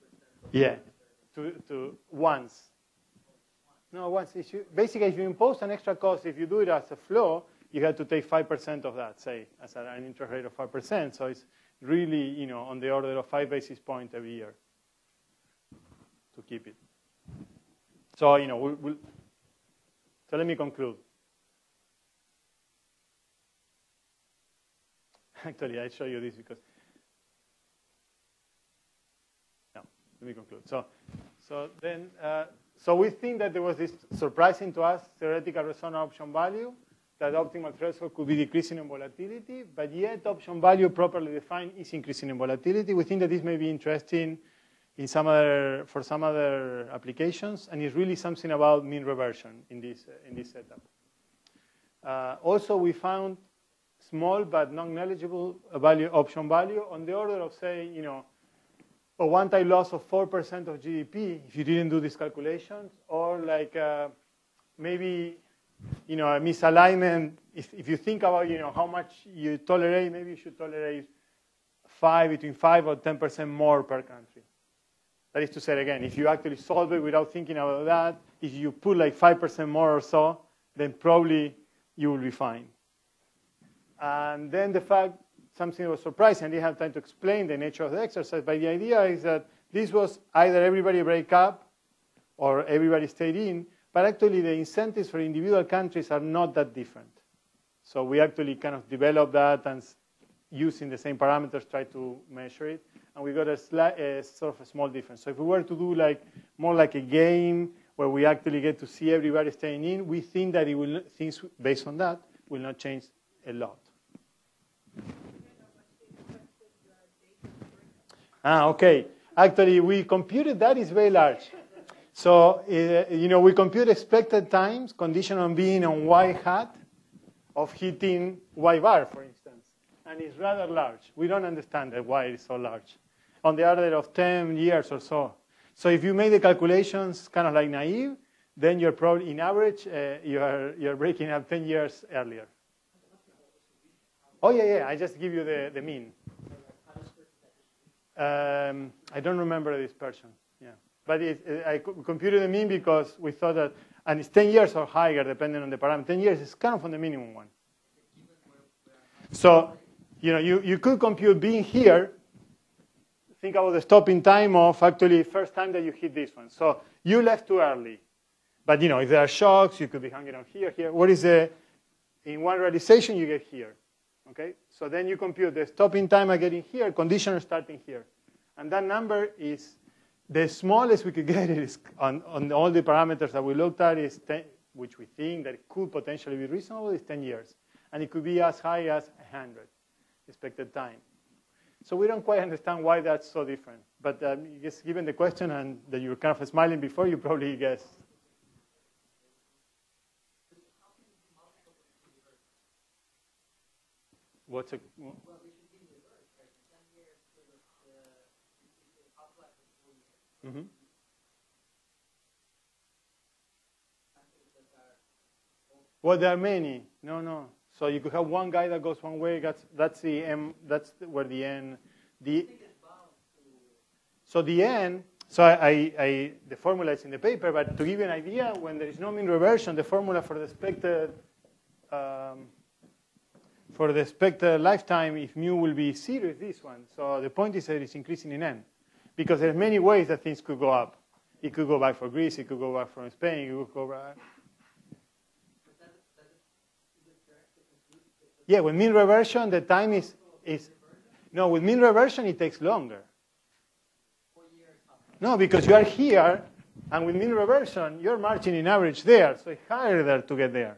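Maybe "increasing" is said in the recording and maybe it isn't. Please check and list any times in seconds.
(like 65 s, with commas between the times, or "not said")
41 s, 237 s.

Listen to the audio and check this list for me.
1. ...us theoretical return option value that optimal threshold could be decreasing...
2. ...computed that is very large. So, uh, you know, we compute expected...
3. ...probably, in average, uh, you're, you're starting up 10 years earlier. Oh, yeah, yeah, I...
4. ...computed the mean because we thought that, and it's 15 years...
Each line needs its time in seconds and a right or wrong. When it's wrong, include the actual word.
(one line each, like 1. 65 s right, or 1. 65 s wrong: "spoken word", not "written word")
1. 34 s right
2. 120 s right
3. 138 s wrong: "breaking", not "starting"
4. 151 s wrong: "10", not "15".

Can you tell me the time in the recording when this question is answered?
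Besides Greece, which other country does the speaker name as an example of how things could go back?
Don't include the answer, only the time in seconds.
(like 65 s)
243 s.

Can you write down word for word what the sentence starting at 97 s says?
So we actually kind of developed that and using the same parameters, try to measure it.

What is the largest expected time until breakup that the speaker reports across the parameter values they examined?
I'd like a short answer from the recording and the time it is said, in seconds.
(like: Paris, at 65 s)
100 years, at 189 s.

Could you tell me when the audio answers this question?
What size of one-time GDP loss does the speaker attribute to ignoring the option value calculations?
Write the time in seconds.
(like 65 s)
60 s.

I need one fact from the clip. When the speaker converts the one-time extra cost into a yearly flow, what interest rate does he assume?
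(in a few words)
5%.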